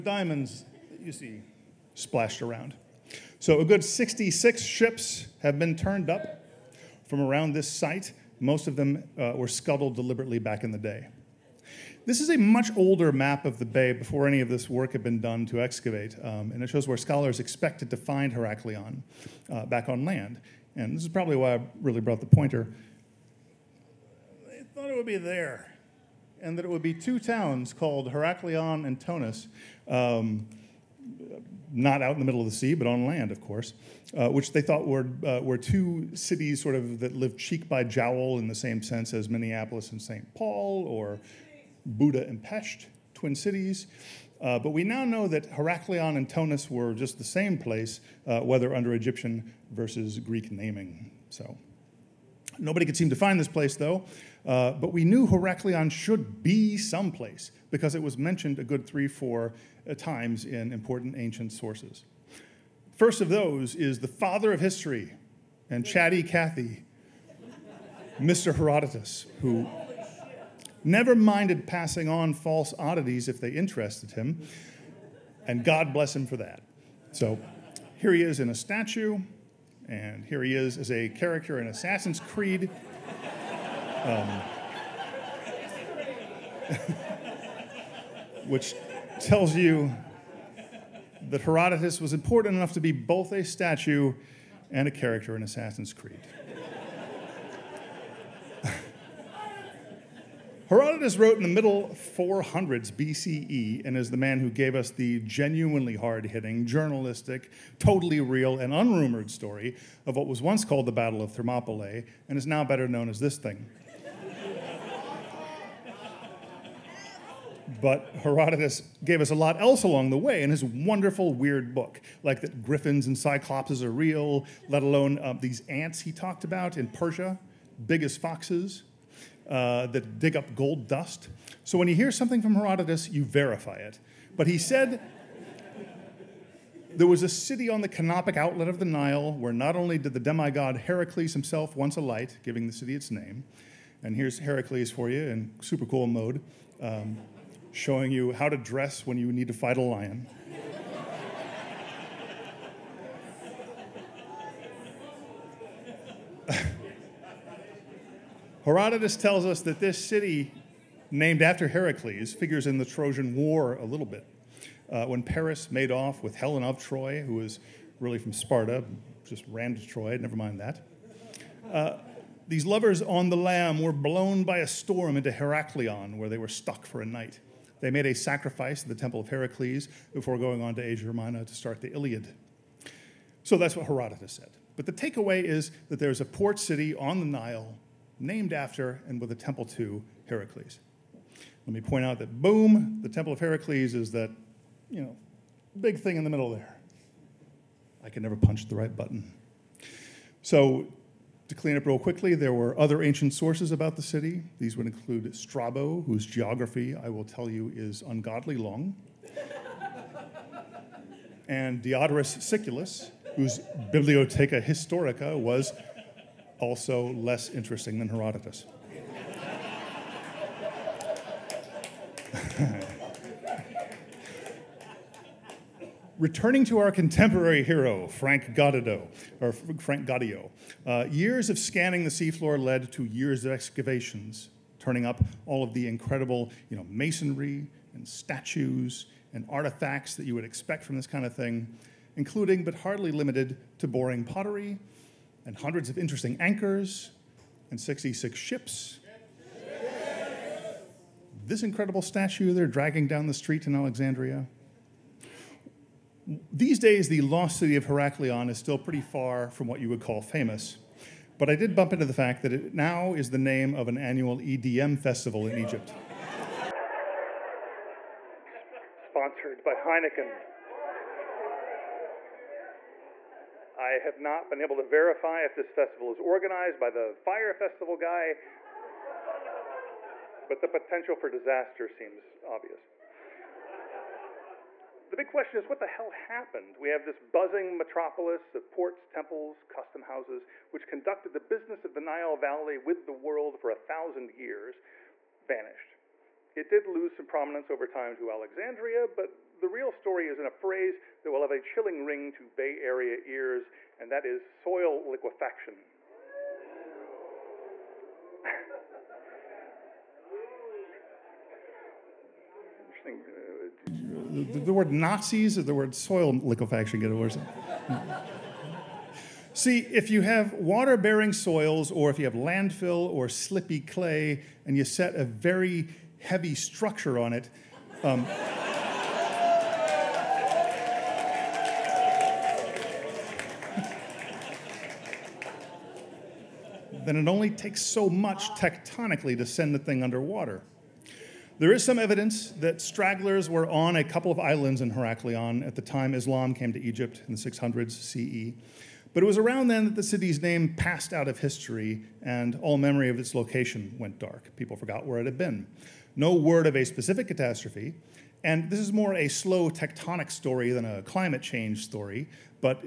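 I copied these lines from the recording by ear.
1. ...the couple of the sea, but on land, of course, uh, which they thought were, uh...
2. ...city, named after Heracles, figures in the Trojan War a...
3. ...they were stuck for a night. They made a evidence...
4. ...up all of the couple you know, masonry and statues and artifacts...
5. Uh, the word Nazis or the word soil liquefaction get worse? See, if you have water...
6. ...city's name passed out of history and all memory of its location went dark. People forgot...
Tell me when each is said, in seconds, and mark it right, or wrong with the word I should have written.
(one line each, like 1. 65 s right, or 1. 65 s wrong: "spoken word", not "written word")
1. 32 s wrong: "middle", not "couple"
2. 160 s right
3. 176 s wrong: "sacrifice", not "evidence"
4. 235 s wrong: "incredible", not "couple"
5. 314 s right
6. 350 s right.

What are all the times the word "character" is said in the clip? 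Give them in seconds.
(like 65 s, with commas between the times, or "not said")
81 s, 94 s.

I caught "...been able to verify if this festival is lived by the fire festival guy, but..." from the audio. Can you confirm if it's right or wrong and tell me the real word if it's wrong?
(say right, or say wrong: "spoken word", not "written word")
wrong: "organized", not "lived".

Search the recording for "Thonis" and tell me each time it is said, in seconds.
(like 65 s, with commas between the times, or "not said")
28 s, 46 s.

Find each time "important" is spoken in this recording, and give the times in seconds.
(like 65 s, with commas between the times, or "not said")
60 s, 92 s.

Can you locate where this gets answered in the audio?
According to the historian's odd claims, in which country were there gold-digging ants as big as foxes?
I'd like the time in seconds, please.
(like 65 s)
126 s.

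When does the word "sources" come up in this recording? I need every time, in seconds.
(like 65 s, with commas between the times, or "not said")
61 s, 203 s.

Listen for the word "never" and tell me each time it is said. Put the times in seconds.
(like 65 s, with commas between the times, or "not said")
70 s, 170 s, 198 s.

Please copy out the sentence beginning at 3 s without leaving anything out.
So, a good 66 ships have been turned up from around this site.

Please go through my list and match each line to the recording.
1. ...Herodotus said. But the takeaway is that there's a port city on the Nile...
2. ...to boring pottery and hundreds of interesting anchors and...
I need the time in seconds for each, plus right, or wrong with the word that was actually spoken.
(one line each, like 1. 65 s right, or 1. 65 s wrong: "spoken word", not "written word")
1. 183 s right
2. 243 s right.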